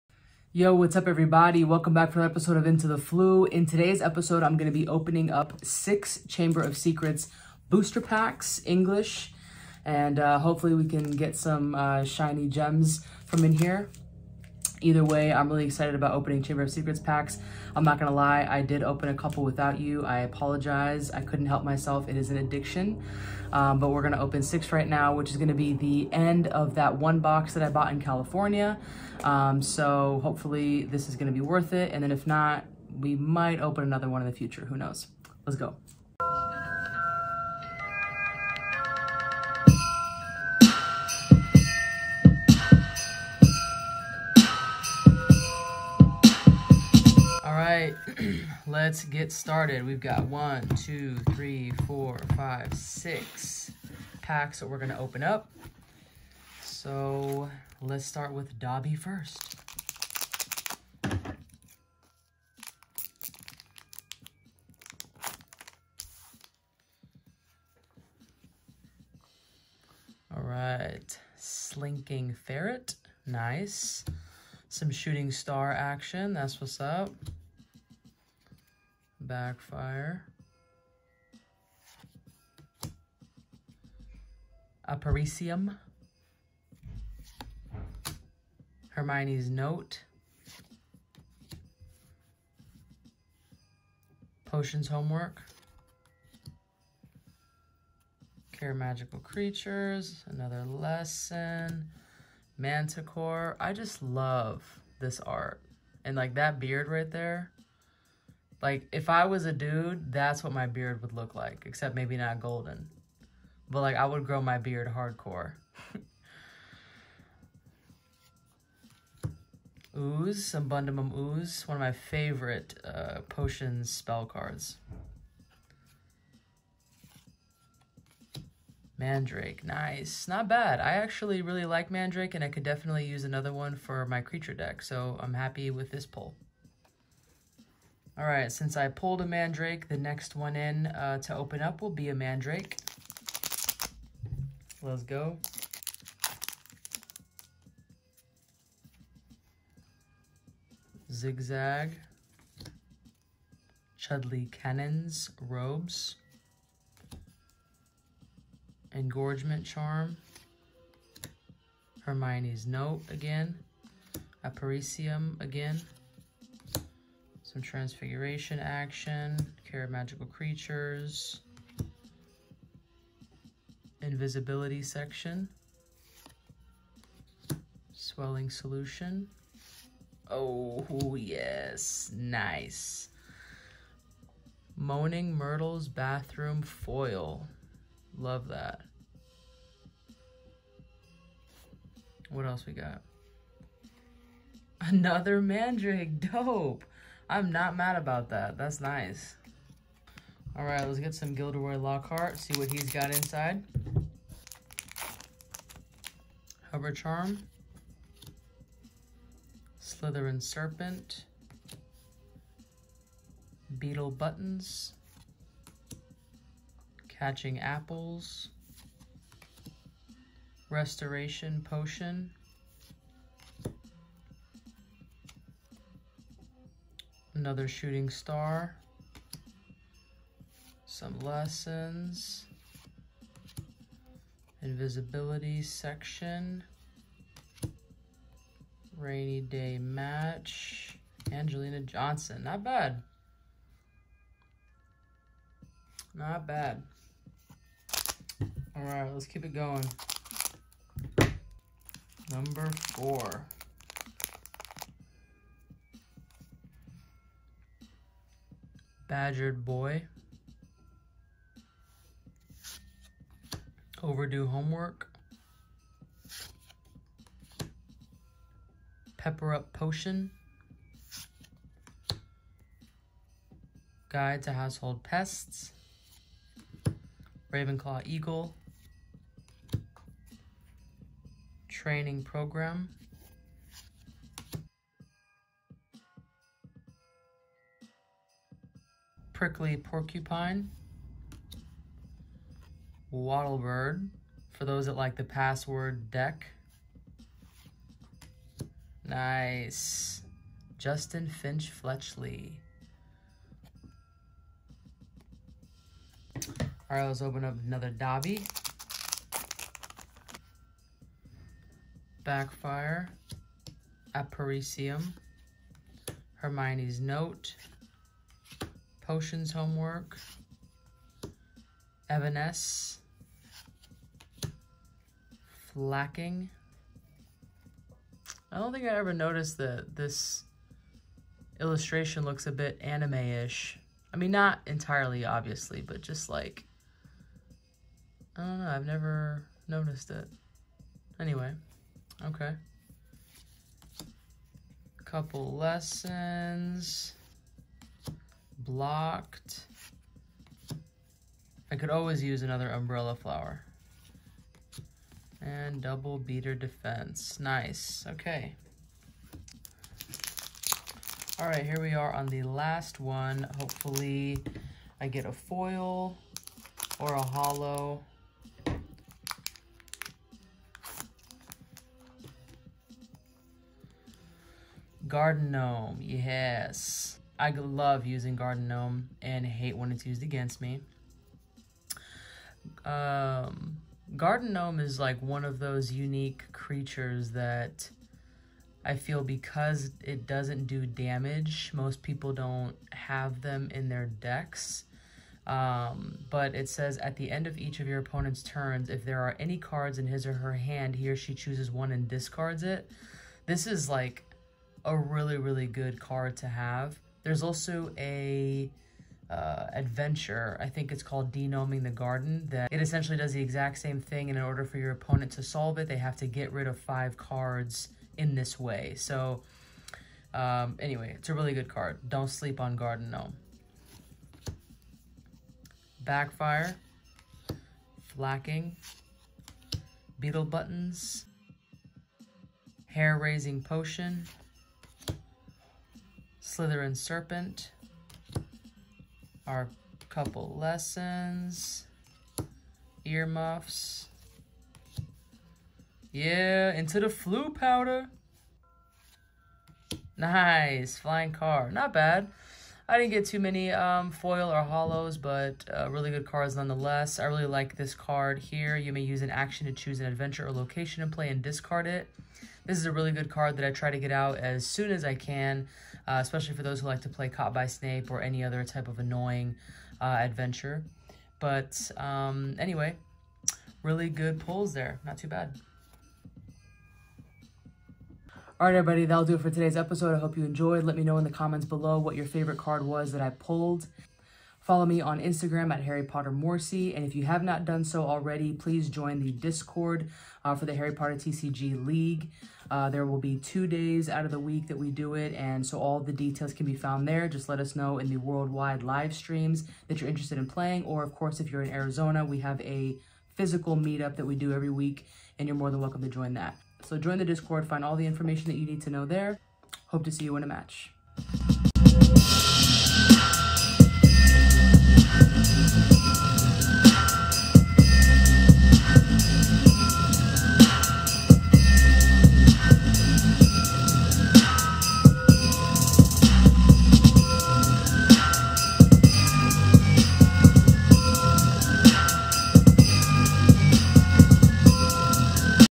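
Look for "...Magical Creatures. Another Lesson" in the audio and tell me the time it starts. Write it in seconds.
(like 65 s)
98 s.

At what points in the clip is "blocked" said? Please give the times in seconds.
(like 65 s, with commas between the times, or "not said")
348 s.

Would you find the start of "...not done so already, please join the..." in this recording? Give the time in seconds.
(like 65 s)
487 s.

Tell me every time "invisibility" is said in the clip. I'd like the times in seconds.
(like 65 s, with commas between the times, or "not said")
174 s, 234 s.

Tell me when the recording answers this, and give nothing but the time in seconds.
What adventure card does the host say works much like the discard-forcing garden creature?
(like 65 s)
411 s.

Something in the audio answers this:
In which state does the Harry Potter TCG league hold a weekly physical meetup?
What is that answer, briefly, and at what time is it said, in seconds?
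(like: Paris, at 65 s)
Arizona, at 501 s.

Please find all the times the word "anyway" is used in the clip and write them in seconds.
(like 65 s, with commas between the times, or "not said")
341 s, 420 s, 472 s.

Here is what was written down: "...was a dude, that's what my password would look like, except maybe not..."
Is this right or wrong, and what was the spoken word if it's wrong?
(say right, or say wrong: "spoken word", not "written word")
wrong: "beard", not "password".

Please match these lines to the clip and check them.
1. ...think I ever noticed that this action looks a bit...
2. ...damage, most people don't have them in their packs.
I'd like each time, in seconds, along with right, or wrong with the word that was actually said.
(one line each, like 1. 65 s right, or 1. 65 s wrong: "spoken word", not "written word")
1. 328 s wrong: "illustration", not "action"
2. 390 s wrong: "decks", not "packs".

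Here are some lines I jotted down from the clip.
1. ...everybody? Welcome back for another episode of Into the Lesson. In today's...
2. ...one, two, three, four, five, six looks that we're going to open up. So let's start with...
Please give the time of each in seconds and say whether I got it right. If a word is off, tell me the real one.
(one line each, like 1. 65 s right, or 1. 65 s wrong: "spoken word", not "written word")
1. 1 s wrong: "Floo", not "Lesson"
2. 50 s wrong: "packs", not "looks".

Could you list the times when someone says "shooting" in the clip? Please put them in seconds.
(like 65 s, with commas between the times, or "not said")
74 s, 227 s.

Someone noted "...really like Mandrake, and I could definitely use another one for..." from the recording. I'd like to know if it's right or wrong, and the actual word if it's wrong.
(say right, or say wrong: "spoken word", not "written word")
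right.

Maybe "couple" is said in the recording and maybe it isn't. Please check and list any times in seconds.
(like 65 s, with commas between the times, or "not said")
19 s, 345 s, 440 s.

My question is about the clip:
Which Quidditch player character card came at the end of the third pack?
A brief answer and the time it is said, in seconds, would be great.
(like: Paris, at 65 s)
Angelina Johnson, at 241 s.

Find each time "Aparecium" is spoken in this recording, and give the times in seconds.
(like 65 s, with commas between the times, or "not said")
84 s, 164 s, 314 s.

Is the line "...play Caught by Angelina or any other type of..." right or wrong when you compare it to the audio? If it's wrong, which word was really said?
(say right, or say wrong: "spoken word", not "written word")
wrong: "Snape", not "Angelina".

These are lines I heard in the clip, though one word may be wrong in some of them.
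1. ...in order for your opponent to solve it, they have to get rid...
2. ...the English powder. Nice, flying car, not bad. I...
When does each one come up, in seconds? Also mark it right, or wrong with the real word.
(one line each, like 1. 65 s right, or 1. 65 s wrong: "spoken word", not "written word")
1. 414 s right
2. 446 s wrong: "Floo", not "English".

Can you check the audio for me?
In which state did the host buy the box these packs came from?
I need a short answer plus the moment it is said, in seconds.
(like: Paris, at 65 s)
California, at 28 s.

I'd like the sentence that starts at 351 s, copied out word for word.
I could always use another umbrella flower.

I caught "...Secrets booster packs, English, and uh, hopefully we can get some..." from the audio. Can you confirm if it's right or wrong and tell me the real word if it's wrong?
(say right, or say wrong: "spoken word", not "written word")
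right.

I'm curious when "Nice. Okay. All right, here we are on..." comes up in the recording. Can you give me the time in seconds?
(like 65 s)
357 s.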